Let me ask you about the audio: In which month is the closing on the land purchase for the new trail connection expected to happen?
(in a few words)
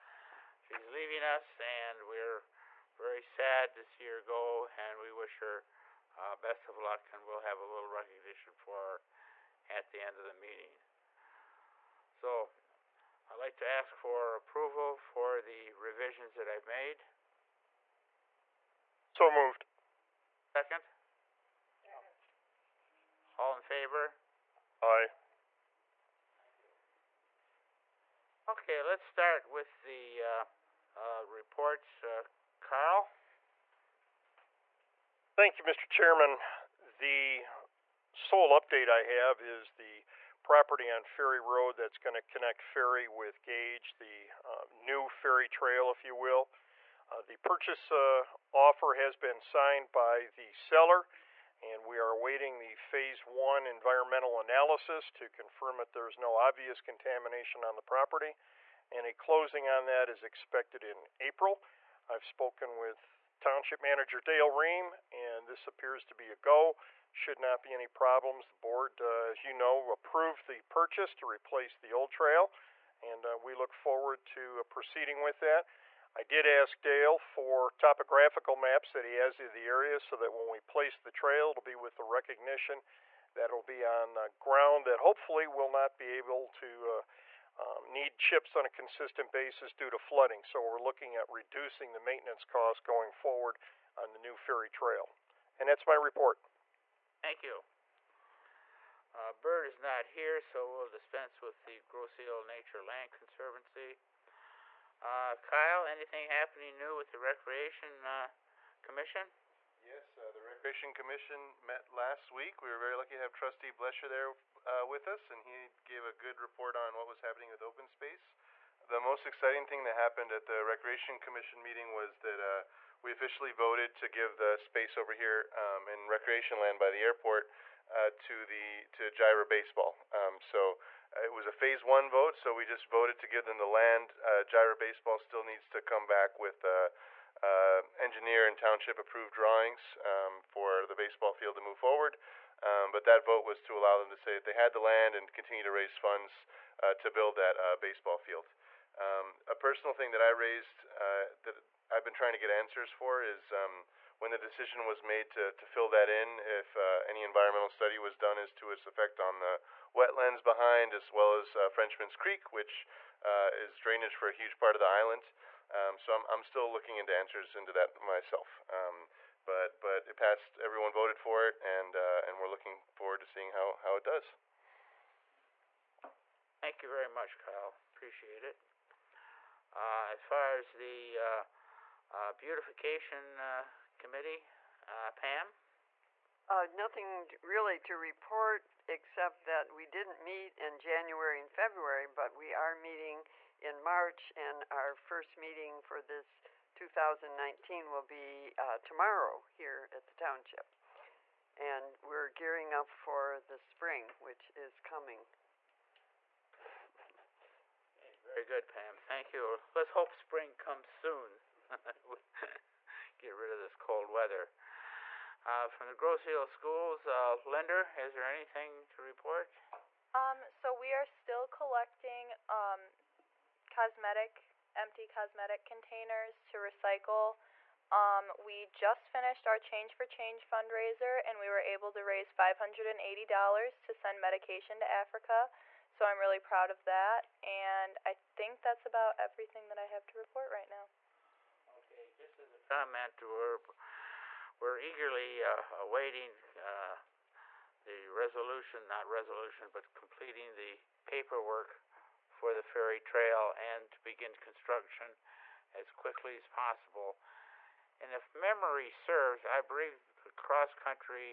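April.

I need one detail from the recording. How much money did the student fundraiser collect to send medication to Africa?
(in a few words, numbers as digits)
$580.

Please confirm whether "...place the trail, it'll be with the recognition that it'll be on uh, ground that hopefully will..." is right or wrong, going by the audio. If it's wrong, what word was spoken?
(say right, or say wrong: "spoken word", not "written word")
right.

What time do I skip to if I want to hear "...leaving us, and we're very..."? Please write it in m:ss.
0:00.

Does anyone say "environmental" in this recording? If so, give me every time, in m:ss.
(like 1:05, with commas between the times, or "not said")
0:53, 2:37.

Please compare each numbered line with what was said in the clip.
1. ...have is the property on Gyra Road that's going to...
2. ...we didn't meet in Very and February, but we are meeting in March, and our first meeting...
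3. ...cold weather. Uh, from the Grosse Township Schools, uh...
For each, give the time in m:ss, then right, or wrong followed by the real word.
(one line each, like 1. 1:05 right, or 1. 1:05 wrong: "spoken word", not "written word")
1. 0:39 wrong: "Ferry", not "Gyra"
2. 3:09 wrong: "January", not "Very"
3. 3:33 wrong: "Ile", not "Township".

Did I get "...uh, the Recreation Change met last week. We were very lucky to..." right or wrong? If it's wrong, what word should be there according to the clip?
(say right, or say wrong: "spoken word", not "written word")
wrong: "Commission", not "Change".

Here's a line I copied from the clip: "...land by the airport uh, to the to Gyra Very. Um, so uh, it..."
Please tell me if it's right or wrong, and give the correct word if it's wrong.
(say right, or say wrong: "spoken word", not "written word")
wrong: "Baseball", not "Very".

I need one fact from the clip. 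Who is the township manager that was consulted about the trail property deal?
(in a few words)
Dale Ream.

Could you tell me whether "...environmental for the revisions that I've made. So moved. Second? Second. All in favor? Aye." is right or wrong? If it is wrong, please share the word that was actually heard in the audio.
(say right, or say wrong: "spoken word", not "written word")
wrong: "approval", not "environmental".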